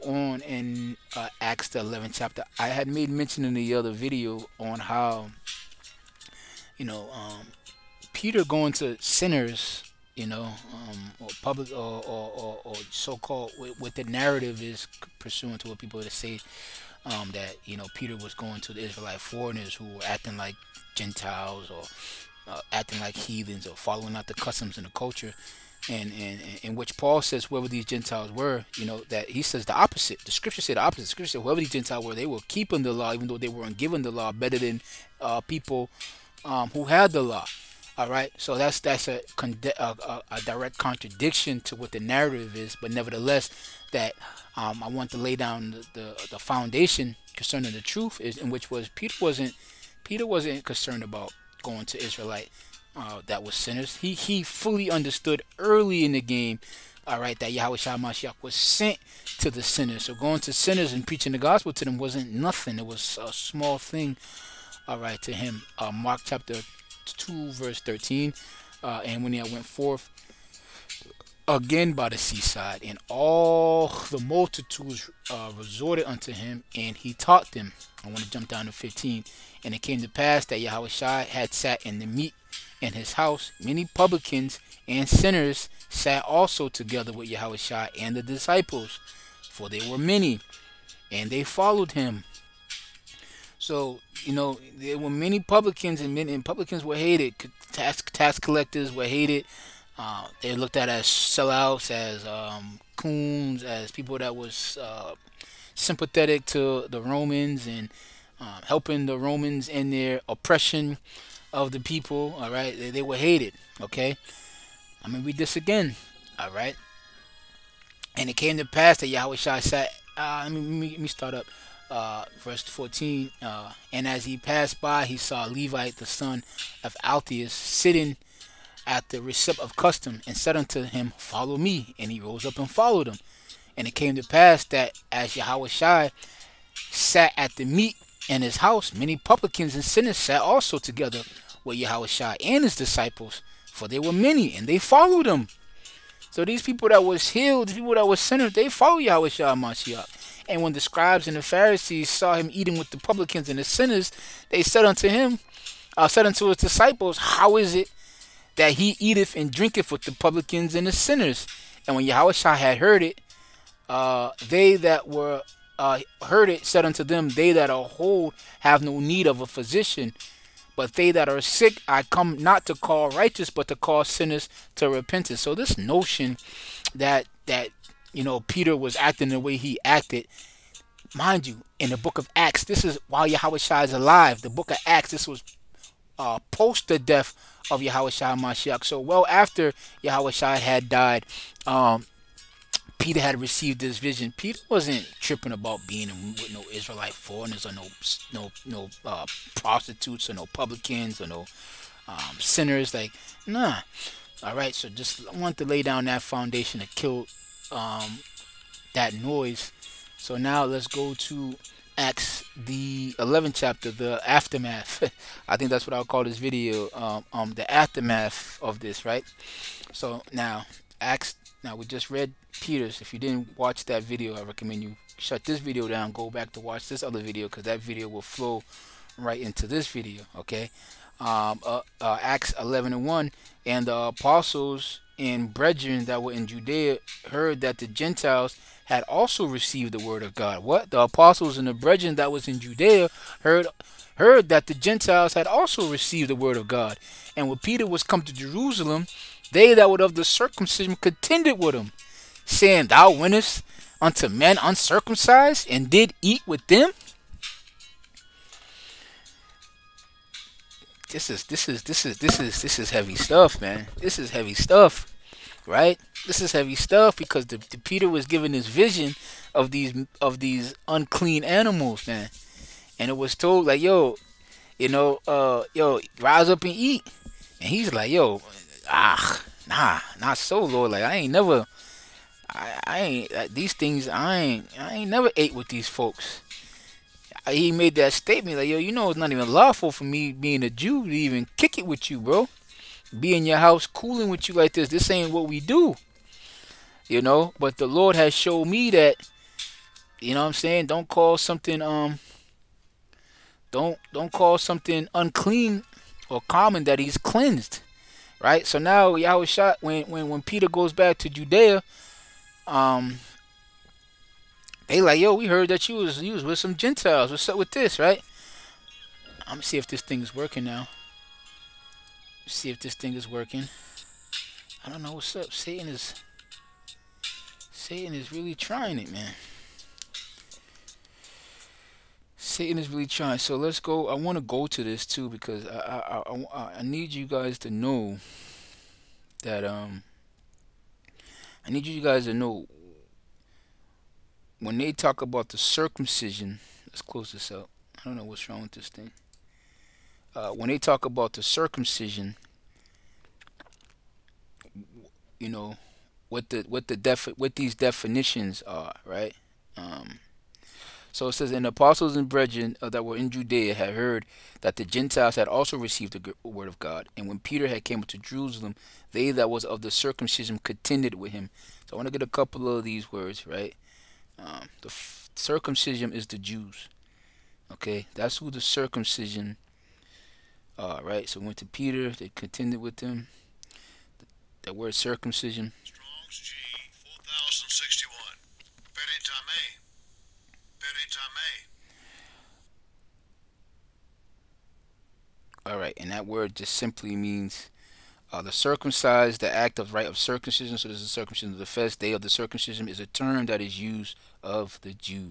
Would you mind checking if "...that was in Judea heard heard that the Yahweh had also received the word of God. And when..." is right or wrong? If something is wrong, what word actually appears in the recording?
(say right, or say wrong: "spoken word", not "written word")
wrong: "Gentiles", not "Yahweh".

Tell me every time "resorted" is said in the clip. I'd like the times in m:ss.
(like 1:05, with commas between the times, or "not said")
1:15.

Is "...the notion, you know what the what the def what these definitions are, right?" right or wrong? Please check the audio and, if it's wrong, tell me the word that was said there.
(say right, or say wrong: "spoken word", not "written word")
wrong: "circumcision", not "notion".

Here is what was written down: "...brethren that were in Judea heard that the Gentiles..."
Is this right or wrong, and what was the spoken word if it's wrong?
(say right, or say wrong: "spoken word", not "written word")
right.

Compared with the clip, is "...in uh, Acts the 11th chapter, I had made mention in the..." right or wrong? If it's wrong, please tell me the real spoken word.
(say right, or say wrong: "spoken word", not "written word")
right.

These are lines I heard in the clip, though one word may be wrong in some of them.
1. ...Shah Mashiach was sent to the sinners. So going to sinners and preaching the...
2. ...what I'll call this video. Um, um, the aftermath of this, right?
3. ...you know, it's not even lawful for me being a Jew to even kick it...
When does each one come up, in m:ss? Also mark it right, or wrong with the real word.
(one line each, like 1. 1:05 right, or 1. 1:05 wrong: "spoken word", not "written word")
1. 0:57 right
2. 3:35 right
3. 4:48 right.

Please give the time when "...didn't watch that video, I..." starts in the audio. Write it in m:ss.
3:43.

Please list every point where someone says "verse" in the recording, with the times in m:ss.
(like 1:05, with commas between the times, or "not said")
1:07, 2:02.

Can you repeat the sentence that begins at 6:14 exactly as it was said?
Um, the circumcision is the Jews.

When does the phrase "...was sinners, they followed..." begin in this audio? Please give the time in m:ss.
2:28.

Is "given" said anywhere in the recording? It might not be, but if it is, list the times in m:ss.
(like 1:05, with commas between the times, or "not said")
0:33, 4:28.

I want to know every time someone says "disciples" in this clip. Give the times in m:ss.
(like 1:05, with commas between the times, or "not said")
1:28, 2:22, 2:36.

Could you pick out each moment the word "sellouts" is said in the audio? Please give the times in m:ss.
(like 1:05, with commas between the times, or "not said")
1:41.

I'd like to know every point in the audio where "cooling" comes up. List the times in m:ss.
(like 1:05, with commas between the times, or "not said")
4:53.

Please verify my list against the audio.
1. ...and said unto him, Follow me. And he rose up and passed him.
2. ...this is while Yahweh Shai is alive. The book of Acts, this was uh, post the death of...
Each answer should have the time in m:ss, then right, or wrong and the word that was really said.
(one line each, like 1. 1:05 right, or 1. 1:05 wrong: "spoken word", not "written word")
1. 2:10 wrong: "followed", not "passed"
2. 3:02 right.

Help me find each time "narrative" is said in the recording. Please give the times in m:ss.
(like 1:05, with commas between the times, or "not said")
0:14, 0:41.